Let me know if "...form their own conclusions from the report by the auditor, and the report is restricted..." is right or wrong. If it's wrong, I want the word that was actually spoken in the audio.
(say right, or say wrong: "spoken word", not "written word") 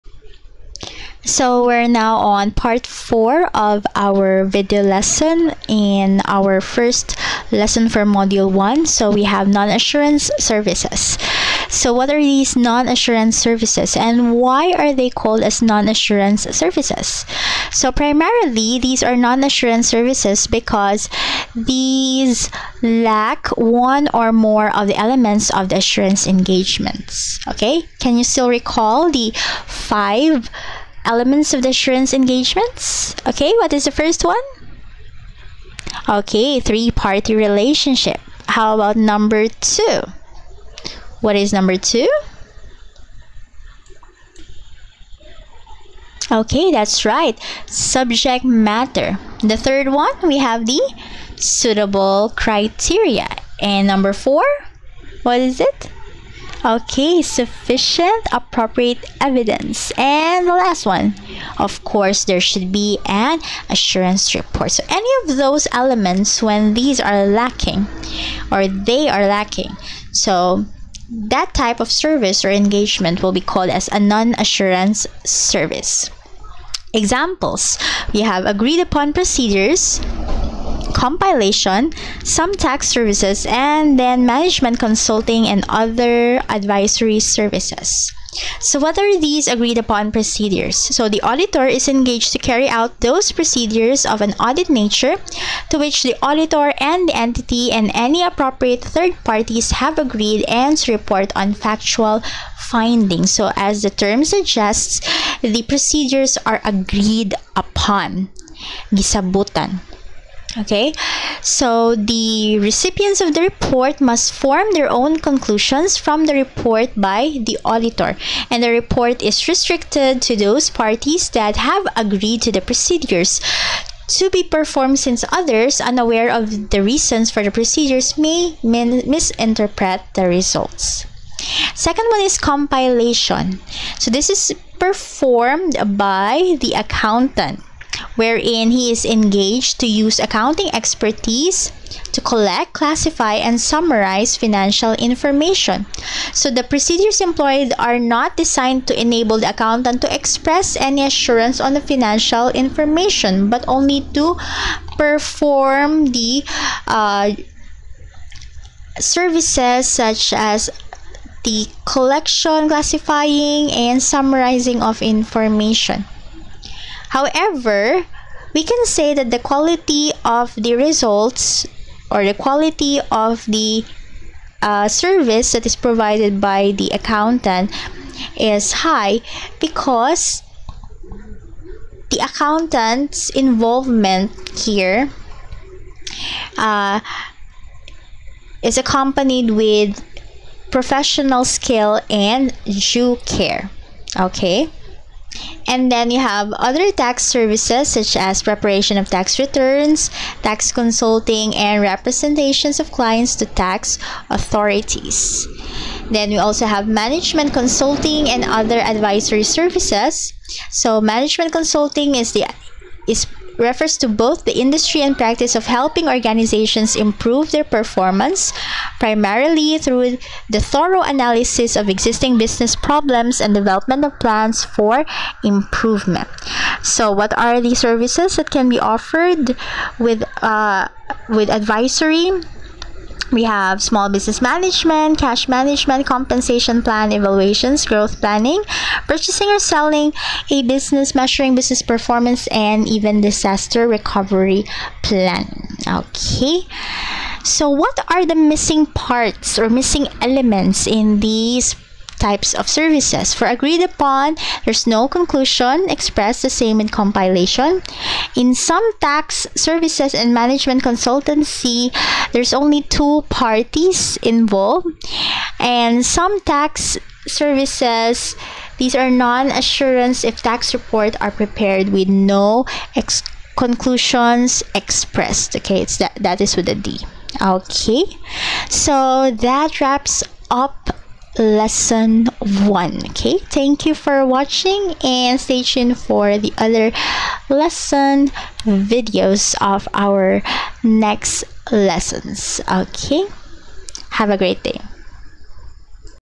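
right.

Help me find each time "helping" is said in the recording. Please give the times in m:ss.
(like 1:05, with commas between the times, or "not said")
3:35.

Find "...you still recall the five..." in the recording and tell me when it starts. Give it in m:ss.
0:28.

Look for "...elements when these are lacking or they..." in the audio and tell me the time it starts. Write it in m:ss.
1:05.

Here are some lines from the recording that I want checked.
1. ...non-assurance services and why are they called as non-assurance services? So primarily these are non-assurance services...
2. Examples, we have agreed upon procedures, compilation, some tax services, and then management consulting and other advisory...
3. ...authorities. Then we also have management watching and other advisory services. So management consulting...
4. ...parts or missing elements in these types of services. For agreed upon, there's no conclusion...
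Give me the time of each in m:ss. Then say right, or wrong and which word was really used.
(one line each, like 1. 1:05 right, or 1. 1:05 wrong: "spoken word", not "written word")
1. 0:12 right
2. 1:16 right
3. 3:24 wrong: "consulting", not "watching"
4. 4:08 right.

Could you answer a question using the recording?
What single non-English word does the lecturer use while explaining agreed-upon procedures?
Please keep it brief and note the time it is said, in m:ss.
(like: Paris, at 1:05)
Gisabutan, at 1:48.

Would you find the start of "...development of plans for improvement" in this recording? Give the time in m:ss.
3:43.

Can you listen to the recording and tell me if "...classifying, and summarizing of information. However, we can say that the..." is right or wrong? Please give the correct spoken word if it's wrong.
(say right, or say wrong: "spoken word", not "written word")
right.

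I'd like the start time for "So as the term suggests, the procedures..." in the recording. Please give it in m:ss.
1:43.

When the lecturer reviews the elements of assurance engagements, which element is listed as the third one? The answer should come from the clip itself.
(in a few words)
Suitable criteria.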